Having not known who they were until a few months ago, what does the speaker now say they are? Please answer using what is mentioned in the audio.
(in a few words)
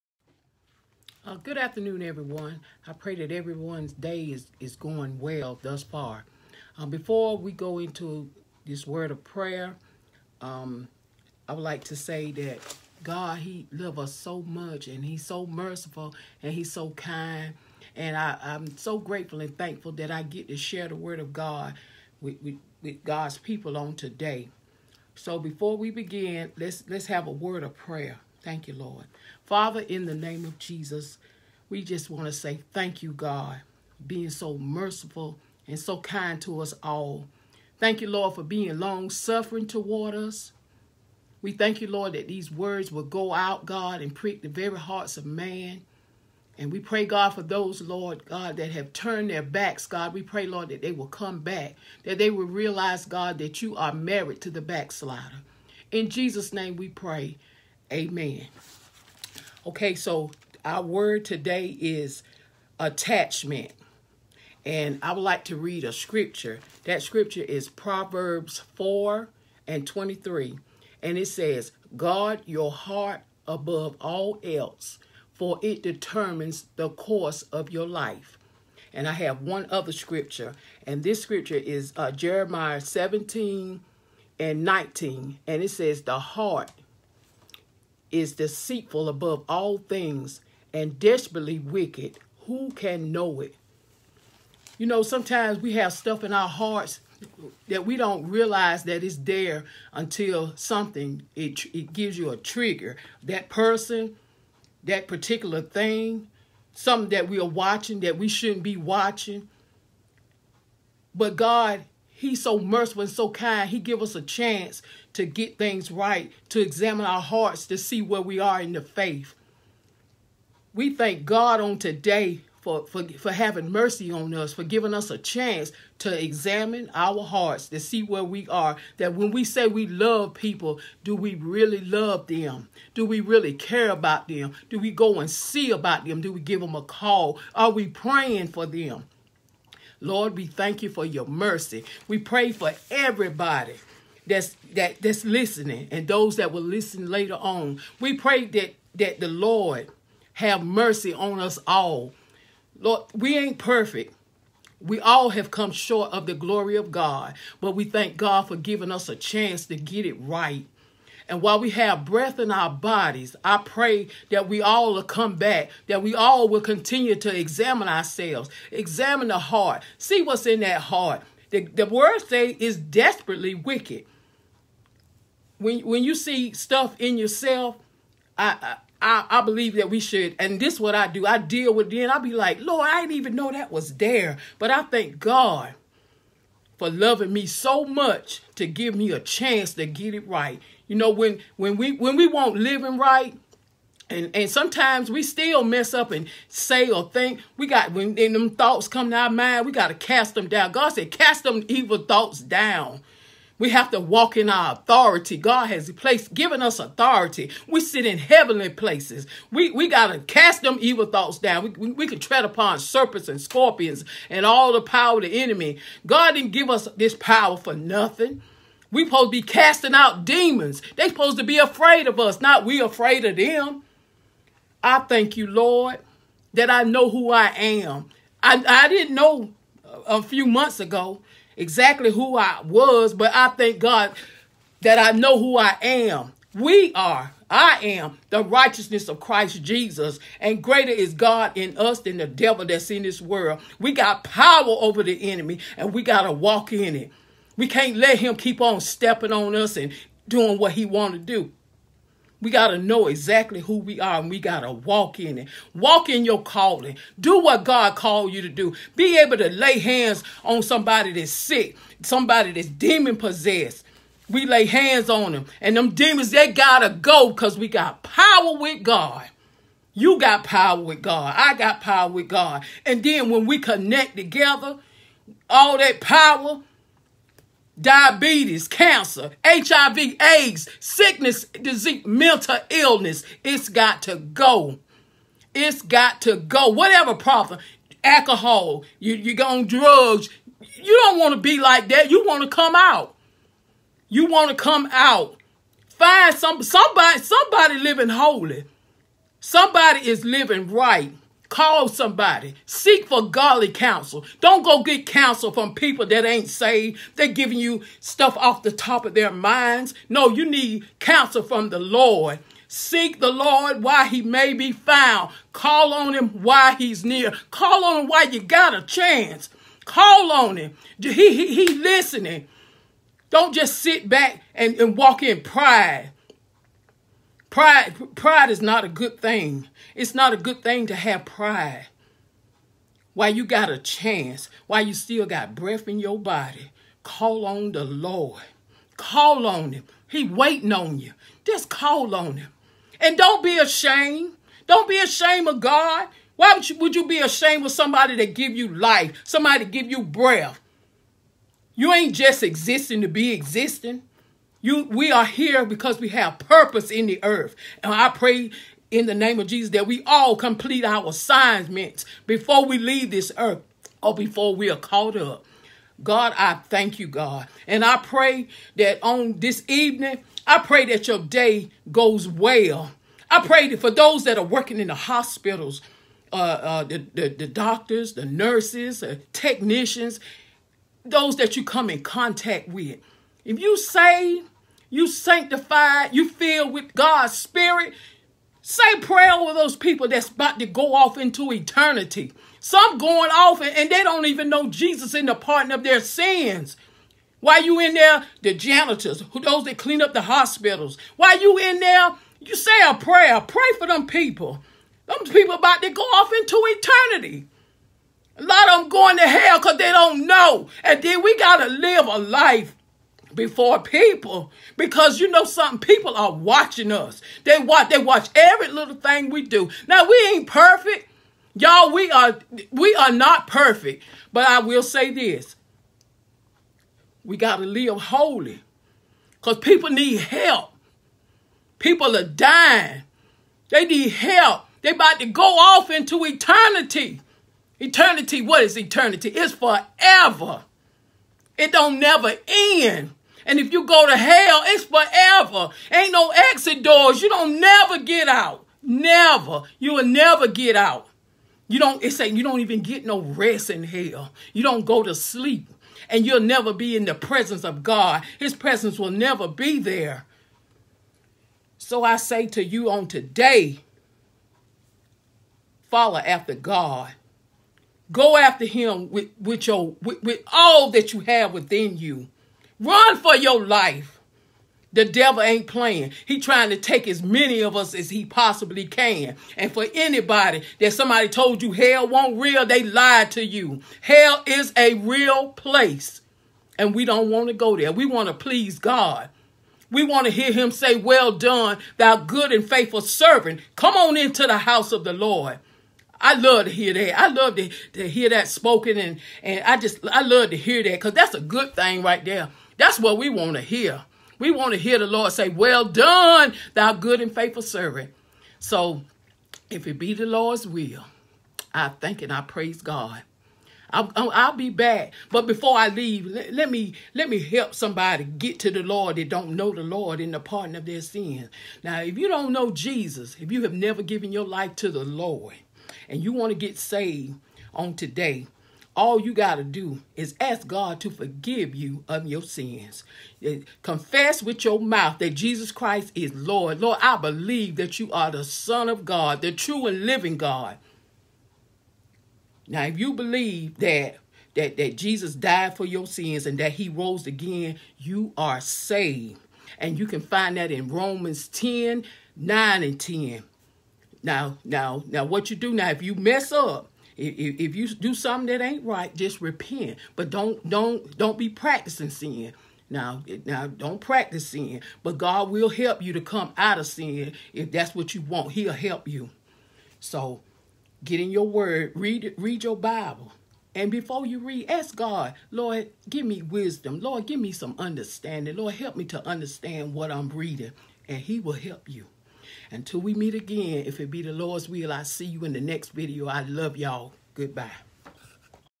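The righteousness of Christ Jesus.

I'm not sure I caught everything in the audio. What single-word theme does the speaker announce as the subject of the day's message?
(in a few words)
Attachment.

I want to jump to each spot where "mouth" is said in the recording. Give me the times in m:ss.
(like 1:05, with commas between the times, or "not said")
8:54.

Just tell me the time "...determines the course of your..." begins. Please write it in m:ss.
1:15.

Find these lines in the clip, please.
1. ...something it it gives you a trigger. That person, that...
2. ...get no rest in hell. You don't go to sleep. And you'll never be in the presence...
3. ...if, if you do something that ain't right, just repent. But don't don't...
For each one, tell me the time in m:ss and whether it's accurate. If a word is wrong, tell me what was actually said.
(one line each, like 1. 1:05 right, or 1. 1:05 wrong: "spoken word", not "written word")
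1. 1:40 right
2. 7:32 right
3. 9:17 right.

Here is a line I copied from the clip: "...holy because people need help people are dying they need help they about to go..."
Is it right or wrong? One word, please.
right.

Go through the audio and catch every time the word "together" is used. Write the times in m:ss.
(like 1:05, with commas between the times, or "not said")
4:34.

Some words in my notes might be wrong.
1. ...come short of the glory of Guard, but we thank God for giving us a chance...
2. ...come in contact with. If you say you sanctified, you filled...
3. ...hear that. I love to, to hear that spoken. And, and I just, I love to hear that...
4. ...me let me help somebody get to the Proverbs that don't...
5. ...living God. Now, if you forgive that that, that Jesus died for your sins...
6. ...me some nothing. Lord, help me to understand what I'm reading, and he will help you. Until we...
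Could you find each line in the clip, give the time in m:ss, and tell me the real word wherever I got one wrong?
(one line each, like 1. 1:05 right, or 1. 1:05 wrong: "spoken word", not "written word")
1. 2:35 wrong: "God", not "Guard"
2. 6:21 right
3. 8:16 right
4. 8:36 wrong: "Lord", not "Proverbs"
5. 9:00 wrong: "believe", not "forgive"
6. 9:37 wrong: "understanding", not "nothing".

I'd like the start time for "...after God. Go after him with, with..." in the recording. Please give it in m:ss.
7:46.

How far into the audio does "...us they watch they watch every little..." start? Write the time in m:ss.
6:56.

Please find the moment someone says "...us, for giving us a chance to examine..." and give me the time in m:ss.
2:04.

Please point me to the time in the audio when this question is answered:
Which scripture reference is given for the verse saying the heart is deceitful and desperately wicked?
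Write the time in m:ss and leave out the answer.
1:22.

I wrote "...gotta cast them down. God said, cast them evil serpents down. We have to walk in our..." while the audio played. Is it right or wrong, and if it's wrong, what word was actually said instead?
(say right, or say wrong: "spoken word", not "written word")
wrong: "thoughts", not "serpents".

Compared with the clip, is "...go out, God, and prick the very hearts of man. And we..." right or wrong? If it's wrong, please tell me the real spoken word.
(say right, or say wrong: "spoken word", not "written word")
right.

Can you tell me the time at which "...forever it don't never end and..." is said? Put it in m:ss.
7:19.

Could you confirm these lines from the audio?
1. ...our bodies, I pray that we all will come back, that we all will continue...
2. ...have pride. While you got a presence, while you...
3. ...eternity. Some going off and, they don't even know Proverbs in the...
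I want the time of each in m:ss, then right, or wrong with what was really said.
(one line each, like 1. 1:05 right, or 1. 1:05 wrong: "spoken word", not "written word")
1. 2:42 right
2. 5:30 wrong: "chance", not "presence"
3. 6:31 wrong: "Jesus", not "Proverbs".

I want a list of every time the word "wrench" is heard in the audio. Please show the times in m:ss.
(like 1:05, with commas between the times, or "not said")
not said.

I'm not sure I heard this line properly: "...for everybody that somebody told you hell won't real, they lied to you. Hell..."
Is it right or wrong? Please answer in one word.
wrong.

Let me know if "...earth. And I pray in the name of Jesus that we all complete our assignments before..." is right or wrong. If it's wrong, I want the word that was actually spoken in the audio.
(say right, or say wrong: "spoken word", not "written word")
right.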